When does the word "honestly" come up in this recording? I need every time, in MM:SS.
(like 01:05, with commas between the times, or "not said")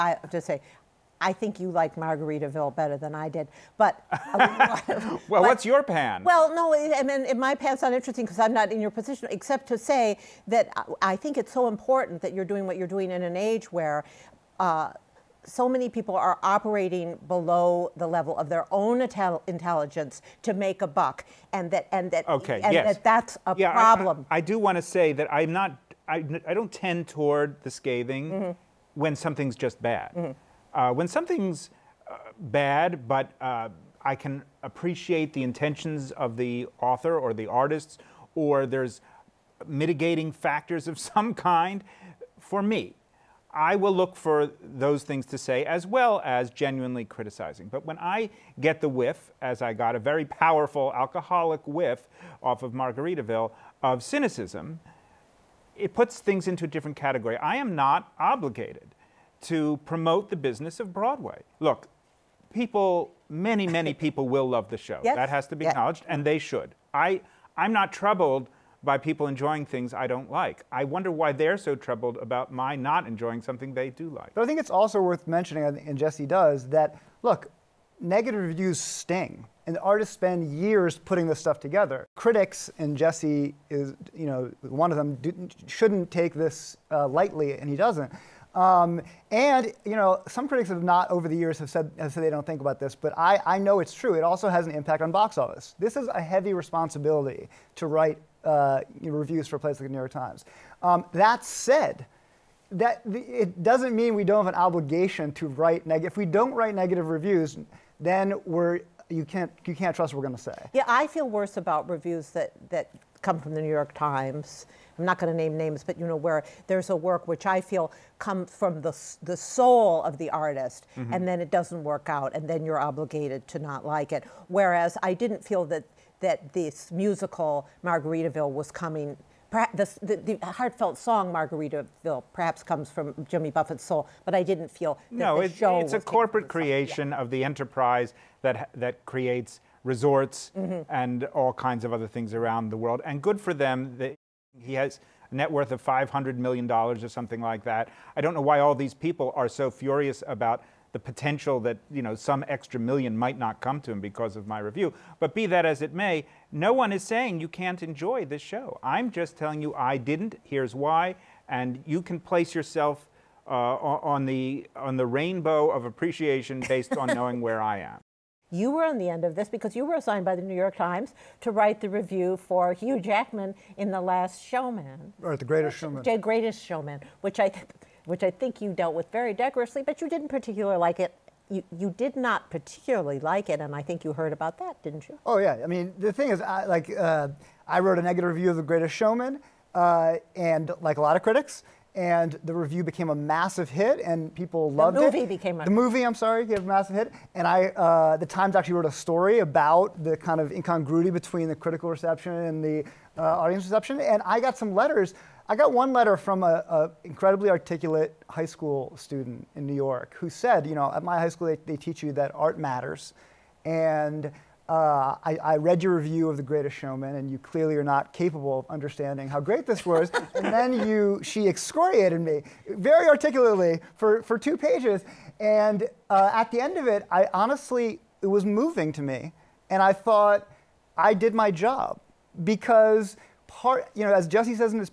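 03:47.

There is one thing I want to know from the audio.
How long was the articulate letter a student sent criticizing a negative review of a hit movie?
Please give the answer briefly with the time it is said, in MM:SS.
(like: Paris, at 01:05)
2 pages, at 03:44.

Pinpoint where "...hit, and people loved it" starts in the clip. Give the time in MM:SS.
03:13.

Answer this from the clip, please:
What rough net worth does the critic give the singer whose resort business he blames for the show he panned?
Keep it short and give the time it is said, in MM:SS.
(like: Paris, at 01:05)
$500 million, at 02:25.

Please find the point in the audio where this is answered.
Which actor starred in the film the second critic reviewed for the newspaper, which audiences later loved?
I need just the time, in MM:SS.
02:52.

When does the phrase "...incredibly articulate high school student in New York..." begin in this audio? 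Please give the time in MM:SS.
03:27.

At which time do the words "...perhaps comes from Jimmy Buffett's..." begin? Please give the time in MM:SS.
02:12.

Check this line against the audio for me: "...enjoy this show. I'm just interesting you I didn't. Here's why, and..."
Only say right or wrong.
wrong.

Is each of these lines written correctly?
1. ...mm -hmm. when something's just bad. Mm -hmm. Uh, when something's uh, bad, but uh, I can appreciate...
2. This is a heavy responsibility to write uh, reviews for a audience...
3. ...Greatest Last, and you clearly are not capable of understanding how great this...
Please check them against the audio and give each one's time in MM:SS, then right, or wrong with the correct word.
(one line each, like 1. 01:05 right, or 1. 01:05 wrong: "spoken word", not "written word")
1. 00:28 right
2. 01:35 wrong: "place", not "audience"
3. 03:36 wrong: "Showman", not "Last".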